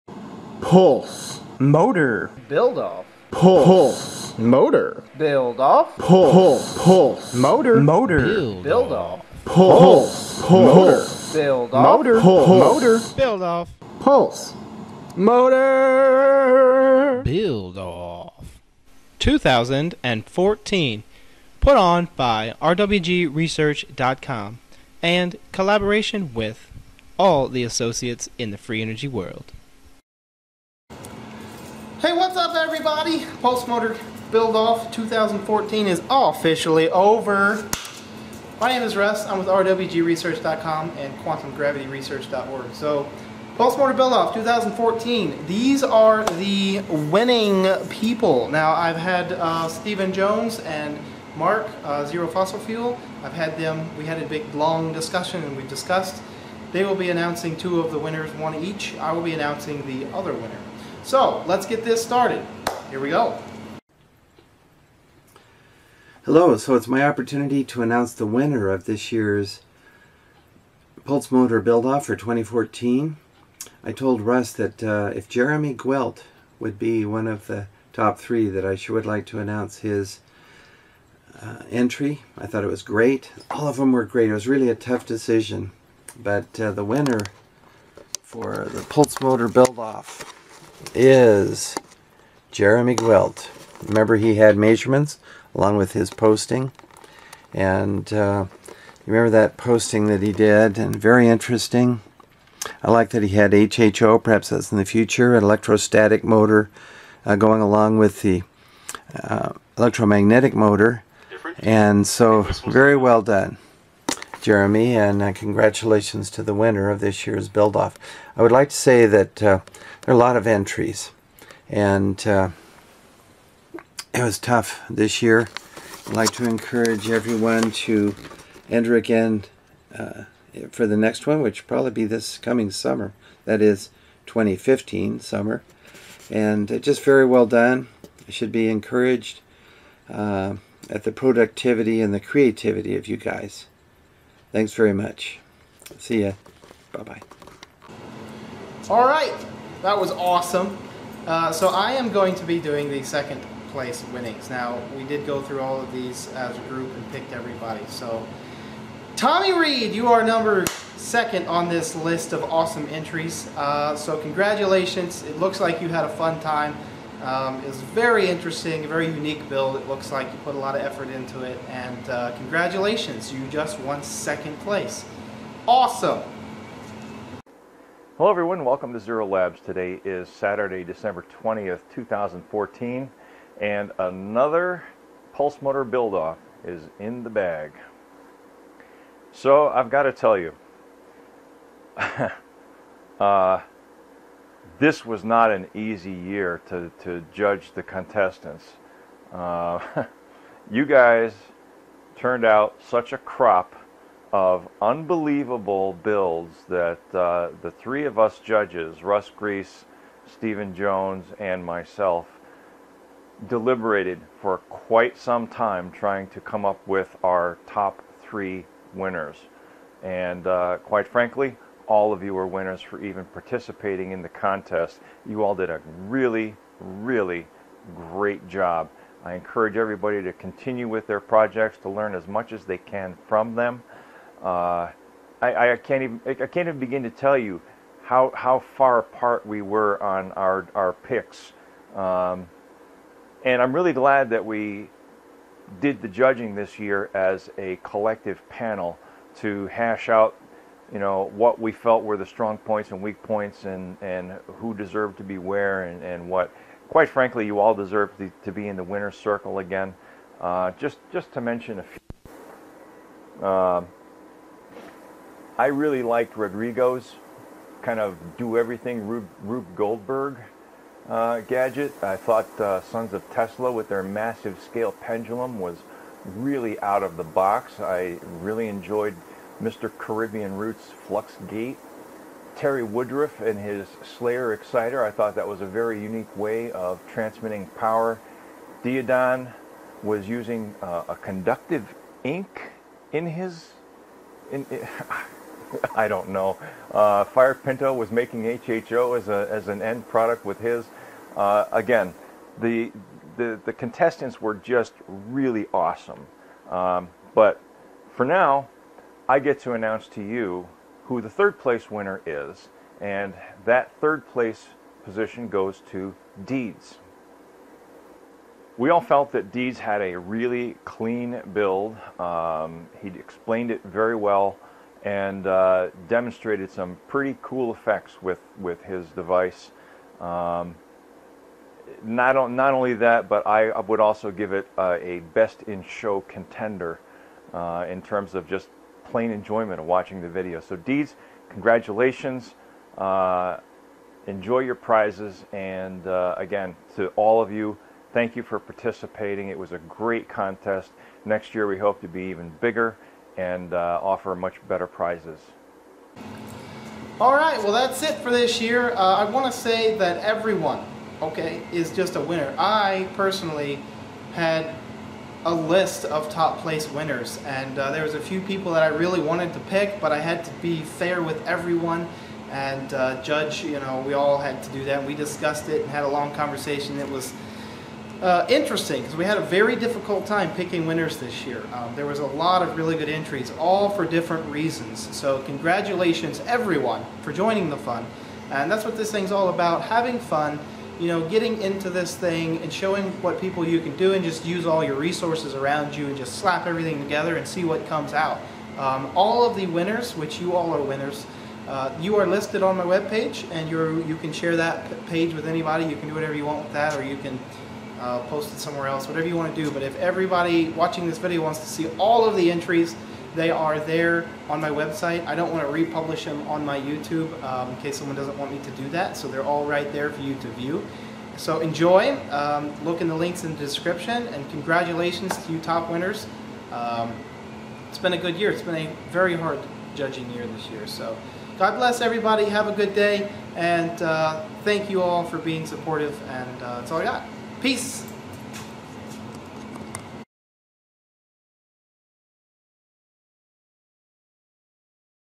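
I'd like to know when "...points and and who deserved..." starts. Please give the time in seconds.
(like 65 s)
253 s.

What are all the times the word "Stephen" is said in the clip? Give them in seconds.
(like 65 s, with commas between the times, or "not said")
49 s, 210 s.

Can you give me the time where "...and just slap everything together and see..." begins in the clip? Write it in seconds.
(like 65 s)
396 s.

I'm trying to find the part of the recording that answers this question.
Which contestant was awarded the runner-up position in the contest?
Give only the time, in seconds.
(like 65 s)
159 s.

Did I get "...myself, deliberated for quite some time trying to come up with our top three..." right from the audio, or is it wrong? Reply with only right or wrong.
right.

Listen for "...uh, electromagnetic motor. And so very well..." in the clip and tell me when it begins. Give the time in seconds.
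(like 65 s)
109 s.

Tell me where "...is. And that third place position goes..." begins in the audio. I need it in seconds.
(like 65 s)
312 s.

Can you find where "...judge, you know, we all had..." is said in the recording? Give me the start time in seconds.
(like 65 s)
373 s.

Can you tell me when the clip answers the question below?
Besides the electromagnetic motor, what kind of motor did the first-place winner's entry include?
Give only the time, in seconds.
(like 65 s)
105 s.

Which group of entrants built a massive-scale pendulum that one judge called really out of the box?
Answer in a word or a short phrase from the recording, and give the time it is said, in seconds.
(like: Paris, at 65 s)
Sons of Tesla, at 272 s.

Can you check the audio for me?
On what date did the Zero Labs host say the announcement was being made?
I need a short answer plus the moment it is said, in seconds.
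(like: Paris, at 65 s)
December 20th, 2014, at 180 s.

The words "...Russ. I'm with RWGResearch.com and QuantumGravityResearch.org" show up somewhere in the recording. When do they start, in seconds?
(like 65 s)
38 s.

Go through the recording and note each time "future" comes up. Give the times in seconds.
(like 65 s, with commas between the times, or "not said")
104 s.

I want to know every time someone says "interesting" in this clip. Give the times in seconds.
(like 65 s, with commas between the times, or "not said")
101 s, 168 s, 378 s.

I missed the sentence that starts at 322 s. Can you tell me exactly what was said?
Um, he explained it very well and uh, demonstrated some pretty cool effects with, with his device.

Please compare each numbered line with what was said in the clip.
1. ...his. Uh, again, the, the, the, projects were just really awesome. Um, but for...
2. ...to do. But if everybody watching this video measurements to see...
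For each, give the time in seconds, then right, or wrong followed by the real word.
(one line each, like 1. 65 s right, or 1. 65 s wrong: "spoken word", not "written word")
1. 300 s wrong: "contestants", not "projects"
2. 409 s wrong: "wants", not "measurements".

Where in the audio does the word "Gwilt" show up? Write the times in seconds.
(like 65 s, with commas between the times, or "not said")
75 s, 92 s.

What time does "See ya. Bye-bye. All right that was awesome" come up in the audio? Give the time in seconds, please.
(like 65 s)
145 s.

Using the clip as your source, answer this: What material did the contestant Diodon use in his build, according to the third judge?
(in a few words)
Conductive ink.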